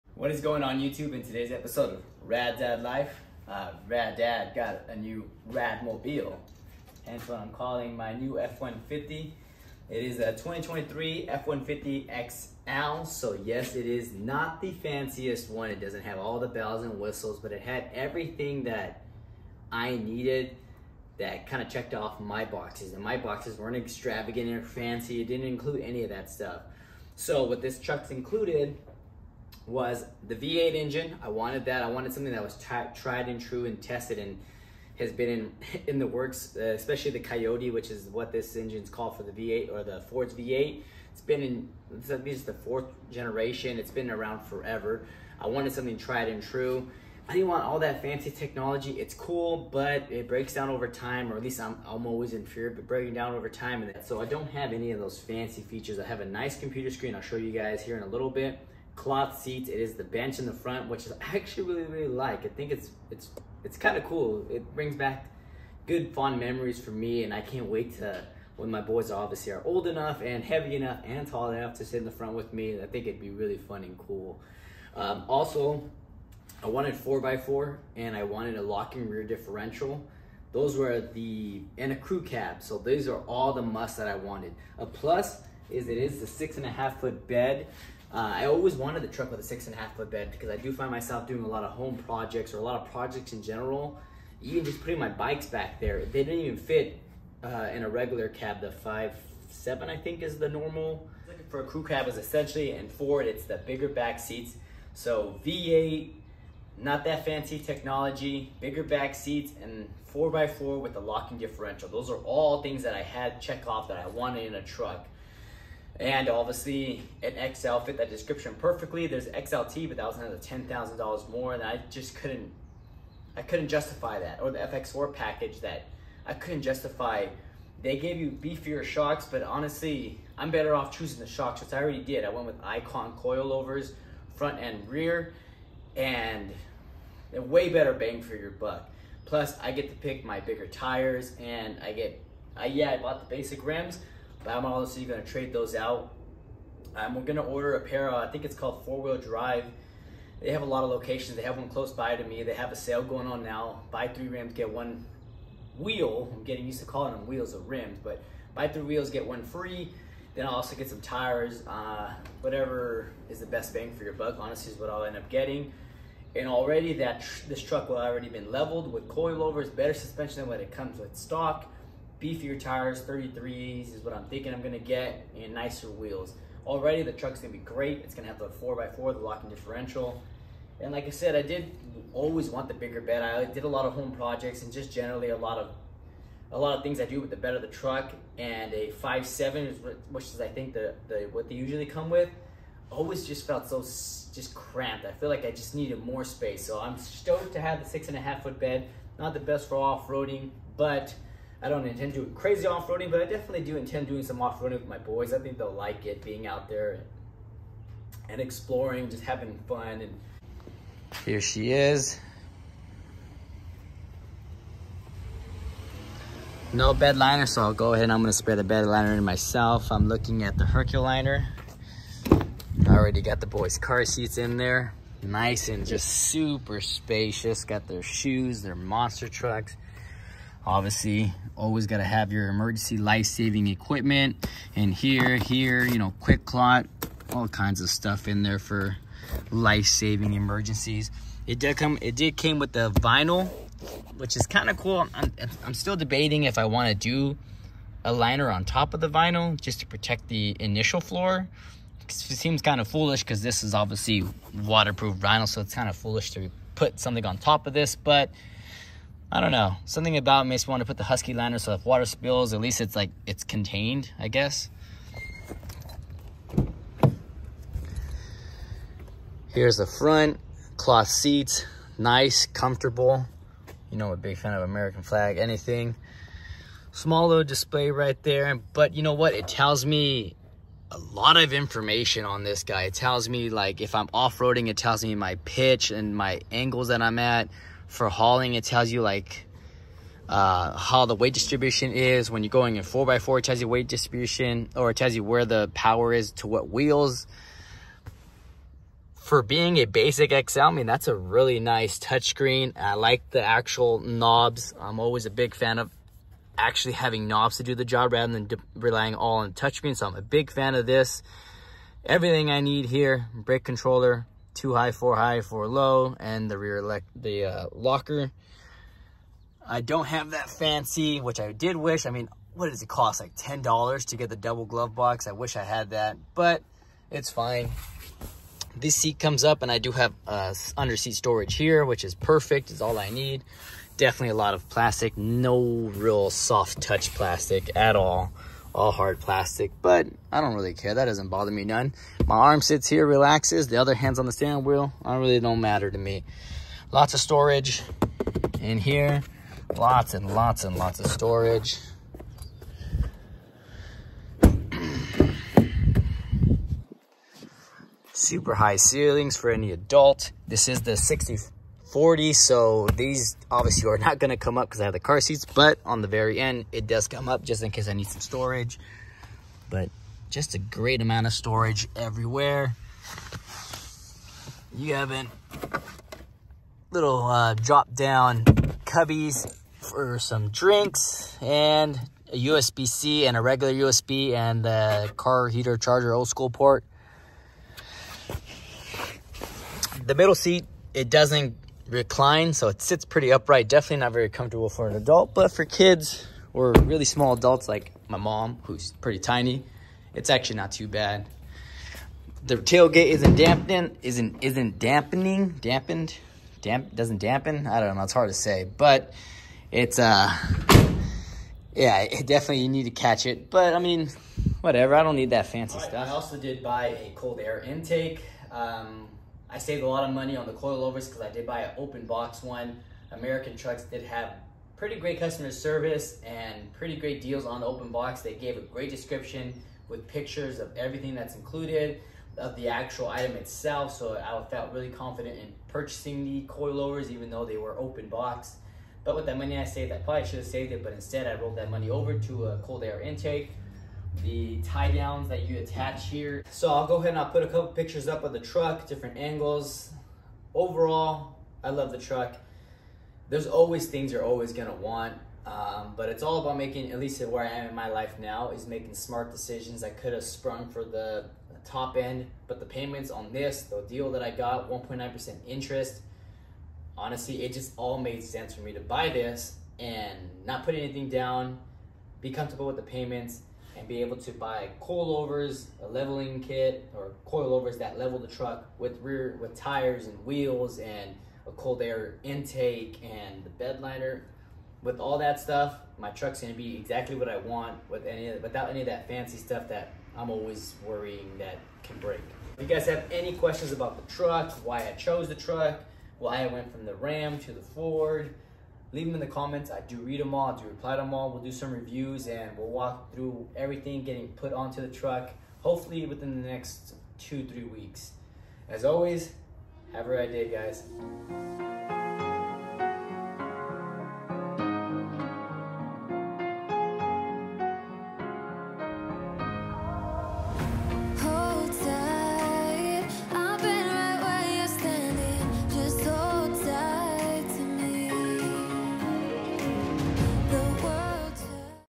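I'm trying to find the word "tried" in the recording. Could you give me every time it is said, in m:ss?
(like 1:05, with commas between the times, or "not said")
0:32, 0:45.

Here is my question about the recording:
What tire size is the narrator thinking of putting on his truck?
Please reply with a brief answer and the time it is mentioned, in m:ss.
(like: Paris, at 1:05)
33s, at 2:53.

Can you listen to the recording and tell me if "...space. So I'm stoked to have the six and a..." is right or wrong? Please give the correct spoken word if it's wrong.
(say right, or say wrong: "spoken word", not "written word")
right.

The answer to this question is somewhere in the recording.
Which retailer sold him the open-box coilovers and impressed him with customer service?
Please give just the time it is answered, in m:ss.
7:03.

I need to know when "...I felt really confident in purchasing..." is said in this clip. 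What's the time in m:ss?
7:14.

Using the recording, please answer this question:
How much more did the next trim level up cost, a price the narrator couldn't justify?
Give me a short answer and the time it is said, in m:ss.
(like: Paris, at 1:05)
$10,000, at 2:00.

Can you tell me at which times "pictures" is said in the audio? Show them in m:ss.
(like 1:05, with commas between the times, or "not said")
7:10, 7:27.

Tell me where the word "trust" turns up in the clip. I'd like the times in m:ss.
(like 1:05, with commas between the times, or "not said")
not said.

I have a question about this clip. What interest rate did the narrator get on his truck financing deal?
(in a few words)
1.9%.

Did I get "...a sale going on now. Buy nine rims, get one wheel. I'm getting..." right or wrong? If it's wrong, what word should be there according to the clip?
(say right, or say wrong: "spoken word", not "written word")
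wrong: "three", not "nine".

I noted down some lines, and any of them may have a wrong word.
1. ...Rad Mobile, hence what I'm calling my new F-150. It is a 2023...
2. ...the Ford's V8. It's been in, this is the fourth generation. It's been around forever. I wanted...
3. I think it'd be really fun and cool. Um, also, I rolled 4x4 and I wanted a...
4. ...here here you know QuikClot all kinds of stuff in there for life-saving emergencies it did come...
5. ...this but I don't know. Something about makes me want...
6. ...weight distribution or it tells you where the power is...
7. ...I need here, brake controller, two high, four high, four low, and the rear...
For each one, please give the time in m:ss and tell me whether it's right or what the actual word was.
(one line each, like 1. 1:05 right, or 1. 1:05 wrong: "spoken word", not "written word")
1. 0:05 right
2. 0:39 right
3. 1:12 wrong: "wanted", not "rolled"
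4. 3:54 right
5. 4:17 right
6. 4:53 right
7. 5:12 right.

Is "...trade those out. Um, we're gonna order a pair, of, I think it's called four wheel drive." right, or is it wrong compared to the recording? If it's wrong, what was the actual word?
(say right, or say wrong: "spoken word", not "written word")
right.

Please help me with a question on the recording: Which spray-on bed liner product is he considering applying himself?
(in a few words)
Herculiner.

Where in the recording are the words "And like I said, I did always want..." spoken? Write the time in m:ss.
3:00.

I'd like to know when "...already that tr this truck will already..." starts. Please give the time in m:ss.
2:46.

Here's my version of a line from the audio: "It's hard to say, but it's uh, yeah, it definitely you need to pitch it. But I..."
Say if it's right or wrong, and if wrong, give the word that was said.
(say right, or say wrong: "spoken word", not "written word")
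wrong: "catch", not "pitch".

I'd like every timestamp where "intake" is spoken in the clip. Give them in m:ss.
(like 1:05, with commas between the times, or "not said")
6:57, 7:23, 8:02.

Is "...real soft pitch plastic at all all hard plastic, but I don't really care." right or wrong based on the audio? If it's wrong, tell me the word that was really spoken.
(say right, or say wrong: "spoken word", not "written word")
wrong: "touch", not "pitch".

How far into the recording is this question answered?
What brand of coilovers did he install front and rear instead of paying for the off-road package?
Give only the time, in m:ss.
2:12.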